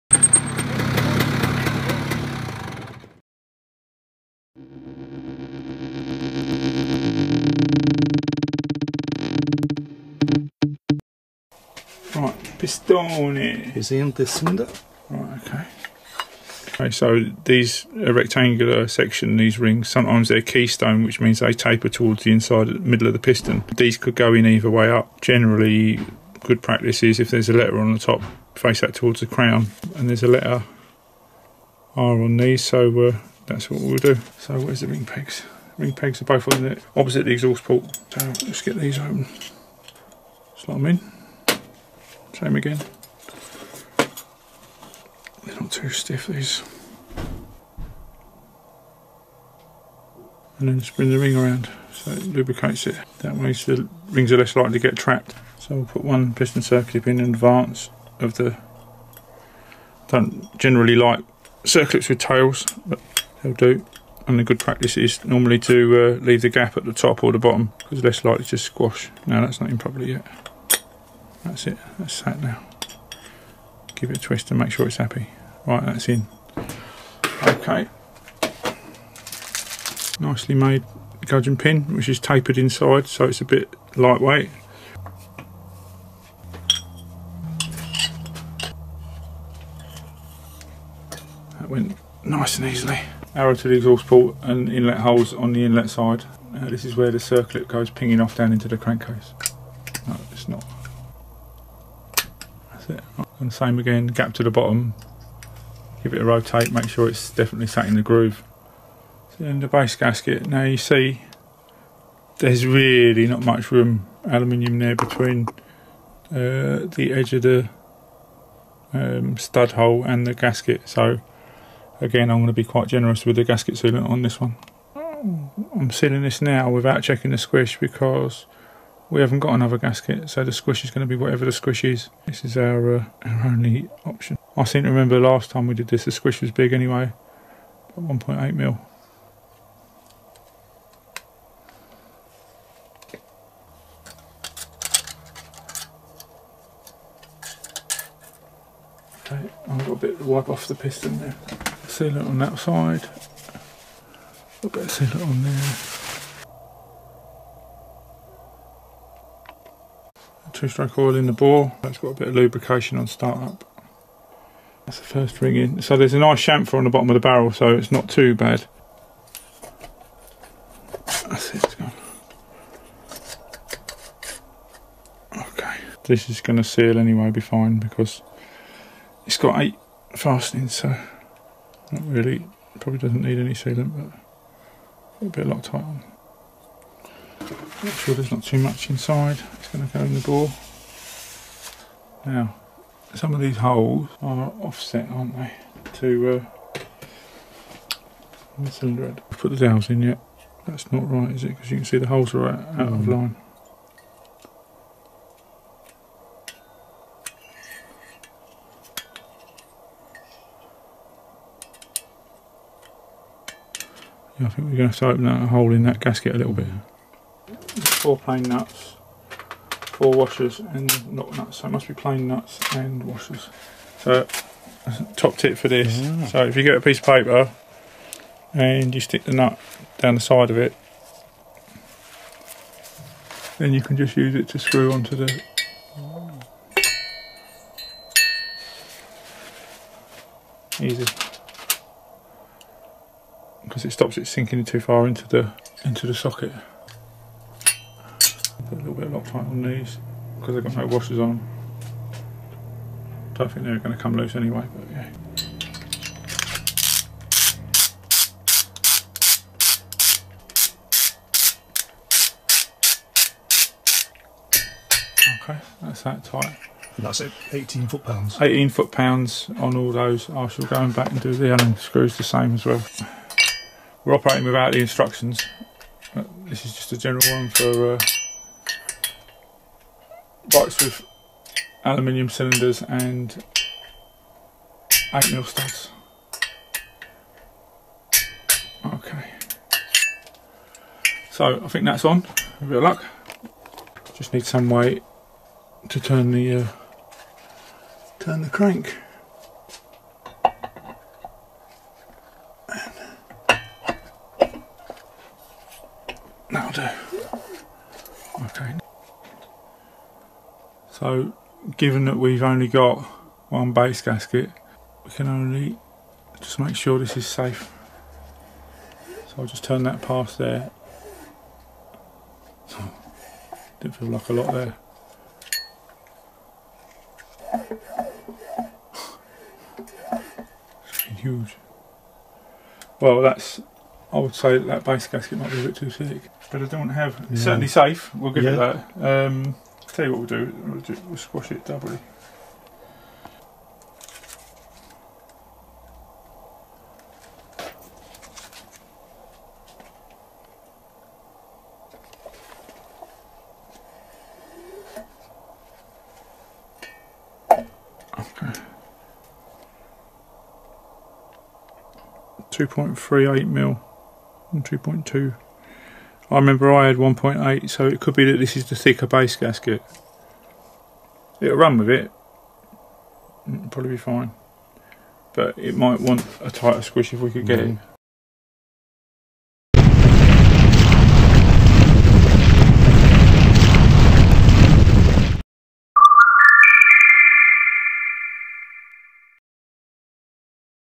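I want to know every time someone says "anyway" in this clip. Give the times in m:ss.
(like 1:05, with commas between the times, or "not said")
2:16, 2:56, 4:14.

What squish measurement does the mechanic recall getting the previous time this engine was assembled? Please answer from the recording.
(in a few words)
1.8 mm.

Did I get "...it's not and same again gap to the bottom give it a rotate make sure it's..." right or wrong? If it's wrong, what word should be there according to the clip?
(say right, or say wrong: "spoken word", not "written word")
right.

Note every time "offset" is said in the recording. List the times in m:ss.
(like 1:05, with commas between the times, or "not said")
3:14.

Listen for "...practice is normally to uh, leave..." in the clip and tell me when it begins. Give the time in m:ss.
1:04.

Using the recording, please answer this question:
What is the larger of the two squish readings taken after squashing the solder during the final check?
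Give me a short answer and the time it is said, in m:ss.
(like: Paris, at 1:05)
2.38 mm, at 6:02.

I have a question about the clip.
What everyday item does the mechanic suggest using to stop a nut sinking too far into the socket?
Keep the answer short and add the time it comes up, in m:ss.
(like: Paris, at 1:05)
A piece of paper, at 3:46.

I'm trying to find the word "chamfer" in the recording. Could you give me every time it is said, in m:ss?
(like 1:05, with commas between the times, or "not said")
2:46.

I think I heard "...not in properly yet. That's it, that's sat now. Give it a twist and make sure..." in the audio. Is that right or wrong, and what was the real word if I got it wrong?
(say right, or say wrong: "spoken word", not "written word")
right.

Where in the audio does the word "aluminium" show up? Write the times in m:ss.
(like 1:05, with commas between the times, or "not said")
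1:54, 4:41.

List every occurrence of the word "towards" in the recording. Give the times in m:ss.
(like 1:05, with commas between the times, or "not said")
0:21, 0:28.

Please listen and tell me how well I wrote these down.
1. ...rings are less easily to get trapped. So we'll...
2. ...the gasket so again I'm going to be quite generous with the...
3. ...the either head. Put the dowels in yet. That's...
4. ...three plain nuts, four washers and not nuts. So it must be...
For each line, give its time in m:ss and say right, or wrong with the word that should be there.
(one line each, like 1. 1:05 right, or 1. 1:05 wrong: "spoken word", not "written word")
1. 0:54 wrong: "likely", not "easily"
2. 2:00 right
3. 3:18 wrong: "cylinder", not "either"
4. 3:38 wrong: "four", not "three".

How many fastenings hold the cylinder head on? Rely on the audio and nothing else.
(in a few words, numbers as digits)
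8.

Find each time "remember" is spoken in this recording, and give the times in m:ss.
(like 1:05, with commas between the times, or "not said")
2:14, 6:06.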